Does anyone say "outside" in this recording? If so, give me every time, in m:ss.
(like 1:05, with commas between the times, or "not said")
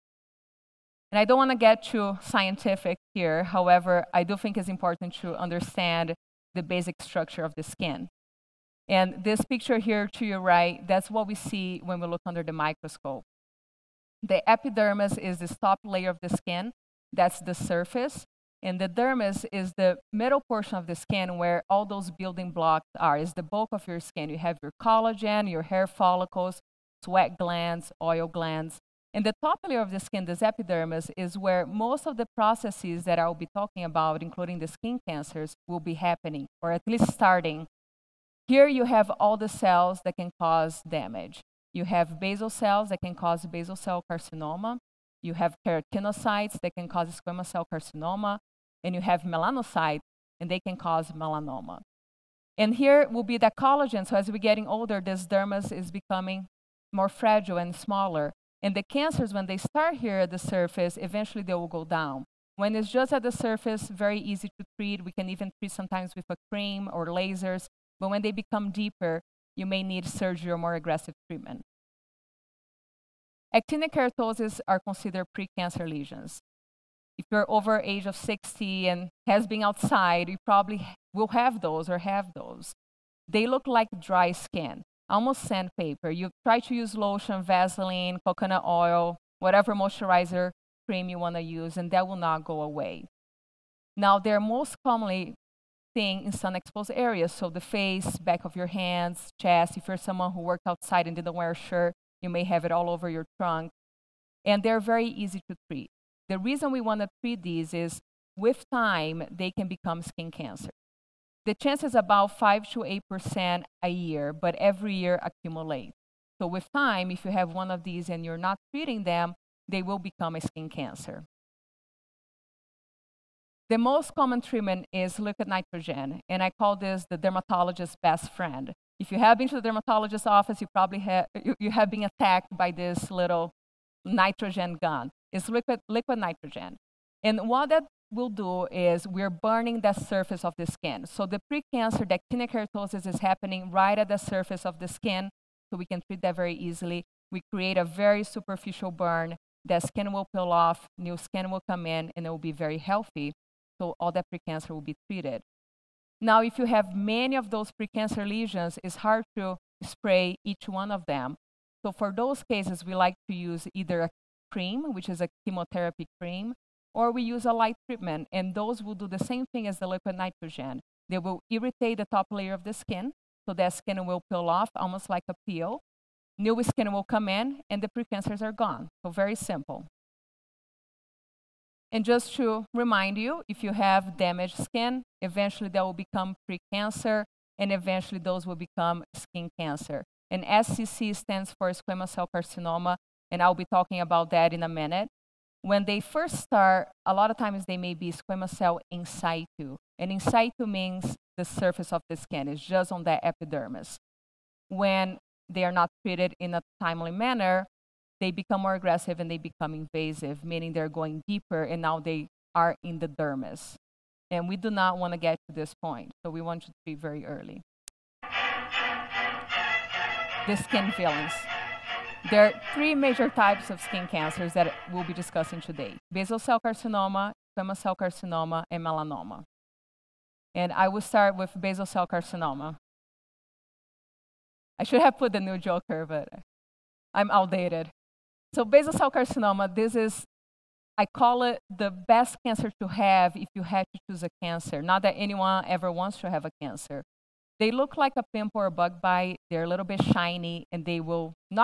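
1:19, 1:40.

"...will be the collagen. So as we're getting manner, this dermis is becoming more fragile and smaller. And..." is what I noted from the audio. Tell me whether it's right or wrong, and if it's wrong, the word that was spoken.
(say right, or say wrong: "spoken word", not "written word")
wrong: "older", not "manner".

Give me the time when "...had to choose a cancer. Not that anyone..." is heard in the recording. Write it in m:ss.
4:03.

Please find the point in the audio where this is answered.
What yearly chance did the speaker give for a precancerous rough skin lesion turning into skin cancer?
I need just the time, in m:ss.
1:52.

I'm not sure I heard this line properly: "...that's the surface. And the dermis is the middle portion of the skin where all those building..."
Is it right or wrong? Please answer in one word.
right.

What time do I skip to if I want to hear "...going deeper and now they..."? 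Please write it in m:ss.
3:30.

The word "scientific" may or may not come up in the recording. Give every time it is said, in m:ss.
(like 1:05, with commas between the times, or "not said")
0:02.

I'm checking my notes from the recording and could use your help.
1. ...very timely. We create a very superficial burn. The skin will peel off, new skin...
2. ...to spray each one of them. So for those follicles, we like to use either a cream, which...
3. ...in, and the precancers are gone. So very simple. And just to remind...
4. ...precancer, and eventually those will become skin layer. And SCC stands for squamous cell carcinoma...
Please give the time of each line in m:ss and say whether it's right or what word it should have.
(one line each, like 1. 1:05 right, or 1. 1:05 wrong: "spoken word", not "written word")
1. 2:26 wrong: "easily", not "timely"
2. 2:39 wrong: "cases", not "follicles"
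3. 2:57 right
4. 3:06 wrong: "cancer", not "layer".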